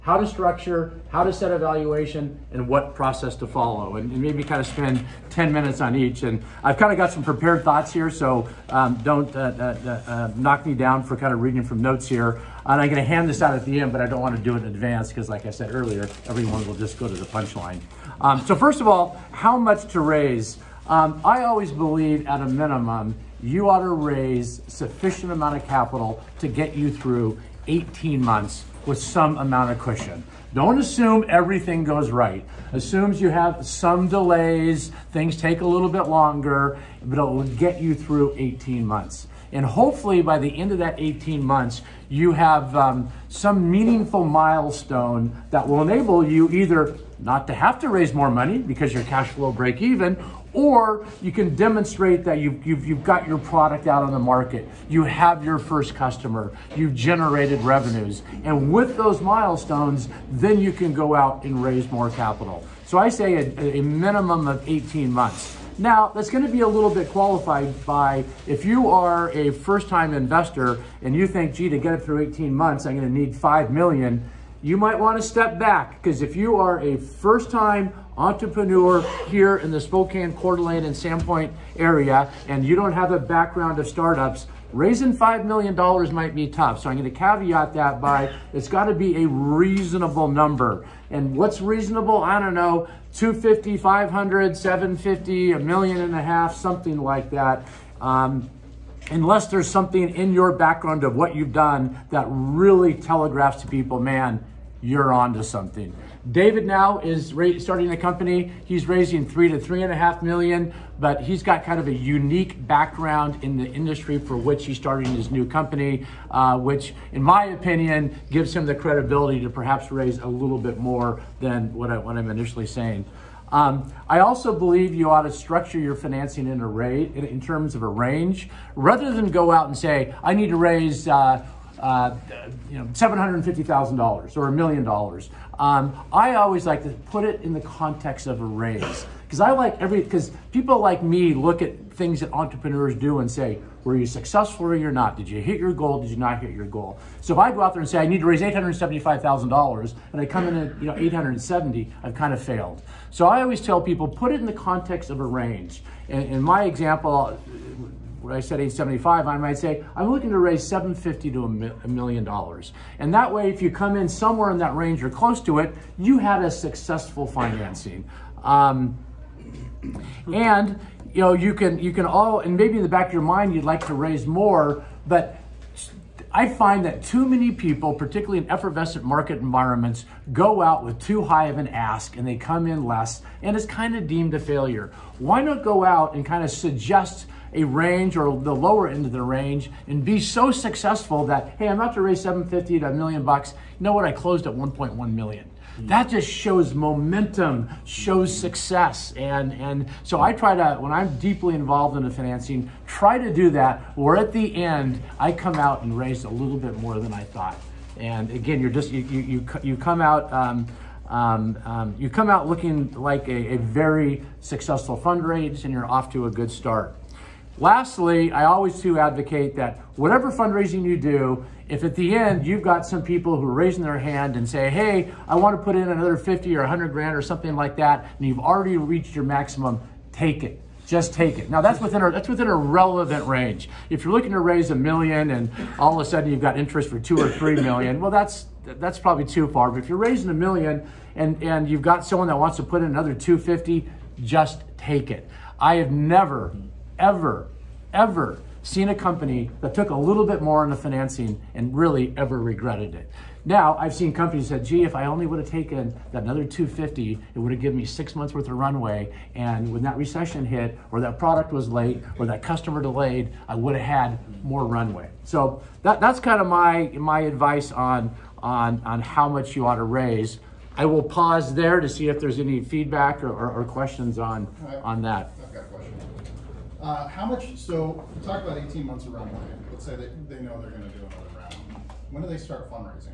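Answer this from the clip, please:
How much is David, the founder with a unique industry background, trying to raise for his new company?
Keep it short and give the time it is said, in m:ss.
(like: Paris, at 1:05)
3 to 3.5 million, at 1:49.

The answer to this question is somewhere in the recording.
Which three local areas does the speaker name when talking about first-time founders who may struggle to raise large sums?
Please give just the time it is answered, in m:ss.
1:19.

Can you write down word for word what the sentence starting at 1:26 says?
So I'm going to caveat that by it's got to be a reasonable number.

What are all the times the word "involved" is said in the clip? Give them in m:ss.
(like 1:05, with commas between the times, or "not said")
3:21.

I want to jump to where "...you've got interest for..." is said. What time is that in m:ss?
3:56.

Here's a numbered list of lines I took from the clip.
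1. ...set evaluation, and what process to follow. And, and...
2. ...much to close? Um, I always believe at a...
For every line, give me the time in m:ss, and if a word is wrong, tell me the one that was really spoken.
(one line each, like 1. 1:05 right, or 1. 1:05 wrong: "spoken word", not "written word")
1. 0:01 right
2. 0:19 wrong: "raise", not "close".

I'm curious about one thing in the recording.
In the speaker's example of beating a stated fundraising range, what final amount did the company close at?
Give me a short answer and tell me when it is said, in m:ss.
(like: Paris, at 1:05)
1.1 million, at 3:14.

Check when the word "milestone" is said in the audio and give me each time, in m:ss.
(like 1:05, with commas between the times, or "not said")
0:44, 0:59.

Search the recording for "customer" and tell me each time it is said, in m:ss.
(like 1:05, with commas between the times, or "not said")
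0:55, 4:22.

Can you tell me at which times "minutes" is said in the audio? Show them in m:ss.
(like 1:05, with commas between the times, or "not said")
0:05.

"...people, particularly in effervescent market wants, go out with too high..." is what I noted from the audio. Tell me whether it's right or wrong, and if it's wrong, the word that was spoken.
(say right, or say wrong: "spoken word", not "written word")
wrong: "environments", not "wants".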